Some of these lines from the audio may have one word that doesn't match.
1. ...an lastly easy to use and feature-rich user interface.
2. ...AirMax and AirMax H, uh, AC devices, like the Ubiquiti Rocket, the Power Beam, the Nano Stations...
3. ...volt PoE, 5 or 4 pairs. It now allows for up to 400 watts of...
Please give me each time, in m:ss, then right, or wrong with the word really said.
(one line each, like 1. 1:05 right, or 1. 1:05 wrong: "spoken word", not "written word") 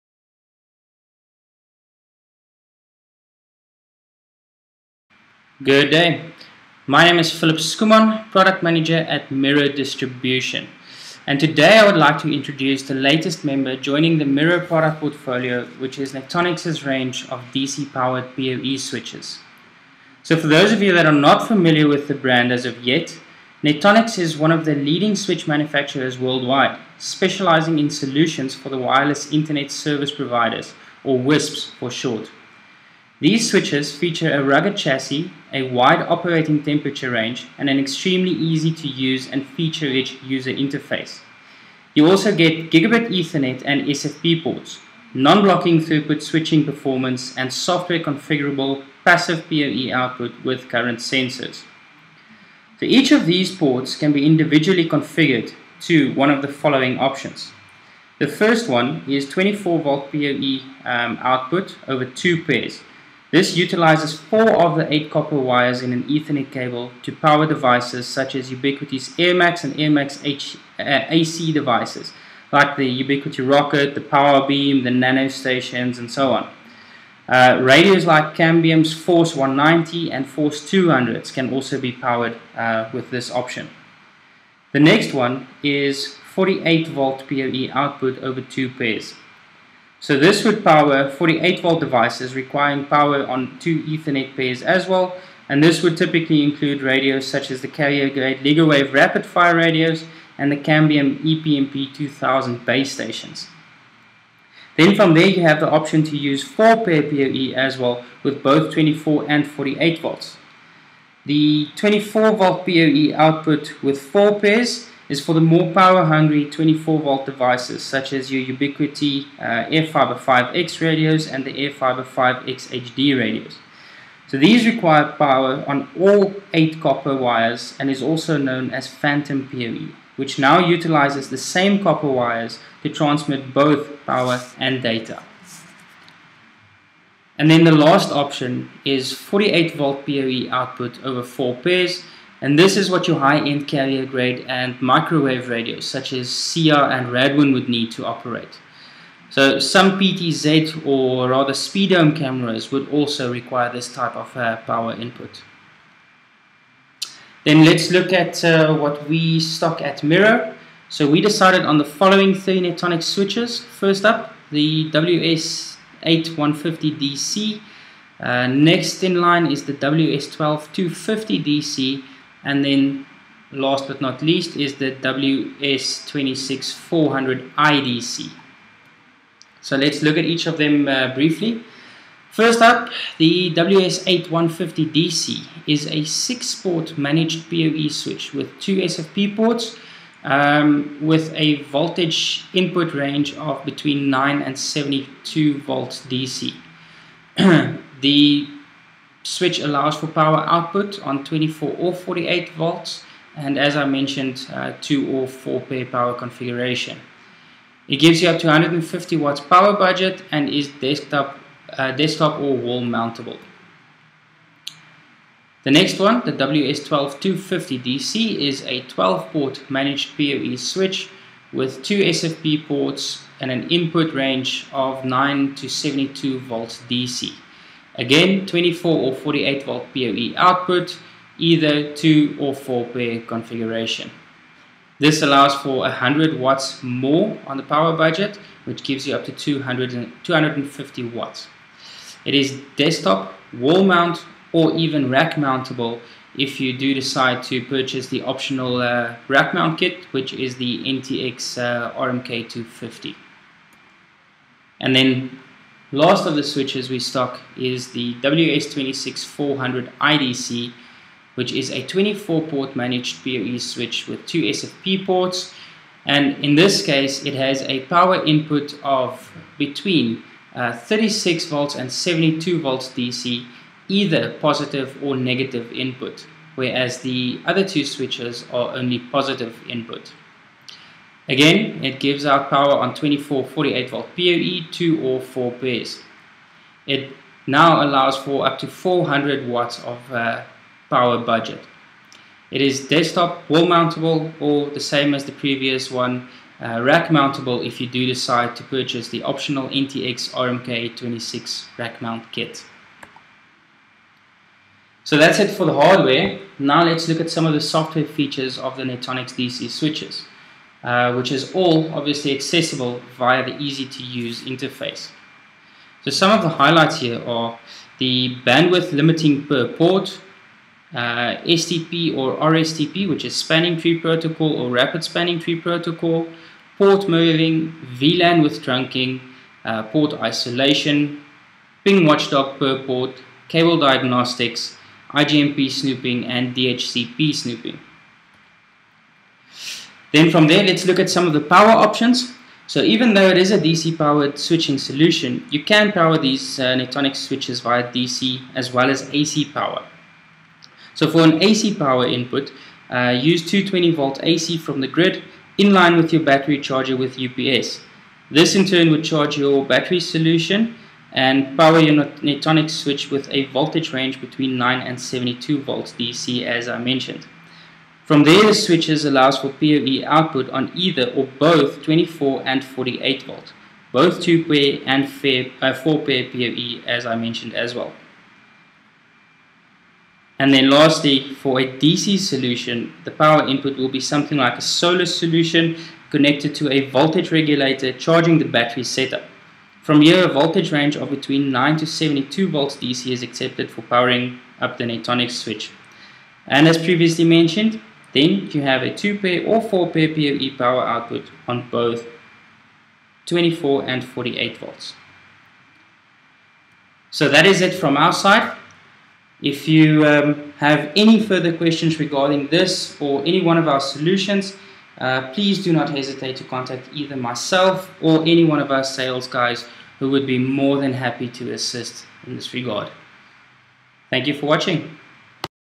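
1. 0:37 wrong: "extremely", not "lastly"
2. 1:09 right
3. 4:43 wrong: "2", not "5".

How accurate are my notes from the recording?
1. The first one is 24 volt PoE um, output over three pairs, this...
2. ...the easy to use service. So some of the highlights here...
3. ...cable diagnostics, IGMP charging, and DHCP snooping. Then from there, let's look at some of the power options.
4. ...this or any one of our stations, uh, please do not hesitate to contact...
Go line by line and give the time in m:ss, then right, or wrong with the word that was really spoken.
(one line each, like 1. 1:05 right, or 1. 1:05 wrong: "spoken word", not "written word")
1. 0:58 wrong: "two", not "three"
2. 5:13 wrong: "interface", not "service"
3. 5:33 wrong: "snooping", not "charging"
4. 6:52 wrong: "solutions", not "stations".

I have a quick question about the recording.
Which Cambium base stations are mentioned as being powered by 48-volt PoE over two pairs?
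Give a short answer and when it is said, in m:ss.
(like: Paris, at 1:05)
EPMP 2000, at 1:41.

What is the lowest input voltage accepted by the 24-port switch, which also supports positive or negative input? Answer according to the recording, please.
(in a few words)
36 volts.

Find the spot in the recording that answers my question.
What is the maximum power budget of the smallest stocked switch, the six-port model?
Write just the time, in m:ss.
3:28.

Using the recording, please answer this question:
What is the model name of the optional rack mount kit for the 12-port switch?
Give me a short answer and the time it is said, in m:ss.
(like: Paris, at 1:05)
NTX RMK250, at 4:10.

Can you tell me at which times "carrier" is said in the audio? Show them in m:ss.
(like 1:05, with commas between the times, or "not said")
1:37, 2:23.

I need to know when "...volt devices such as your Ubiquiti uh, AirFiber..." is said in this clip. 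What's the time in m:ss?
1:57.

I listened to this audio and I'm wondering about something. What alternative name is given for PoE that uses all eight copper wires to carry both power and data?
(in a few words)
Phantom PoE.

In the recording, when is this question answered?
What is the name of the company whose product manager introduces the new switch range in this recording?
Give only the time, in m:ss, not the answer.
0:09.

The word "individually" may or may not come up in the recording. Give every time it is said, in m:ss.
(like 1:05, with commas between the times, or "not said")
0:54.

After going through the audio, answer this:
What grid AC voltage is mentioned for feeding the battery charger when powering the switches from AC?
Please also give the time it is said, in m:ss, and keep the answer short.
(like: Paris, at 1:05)
220 volts AC, at 5:53.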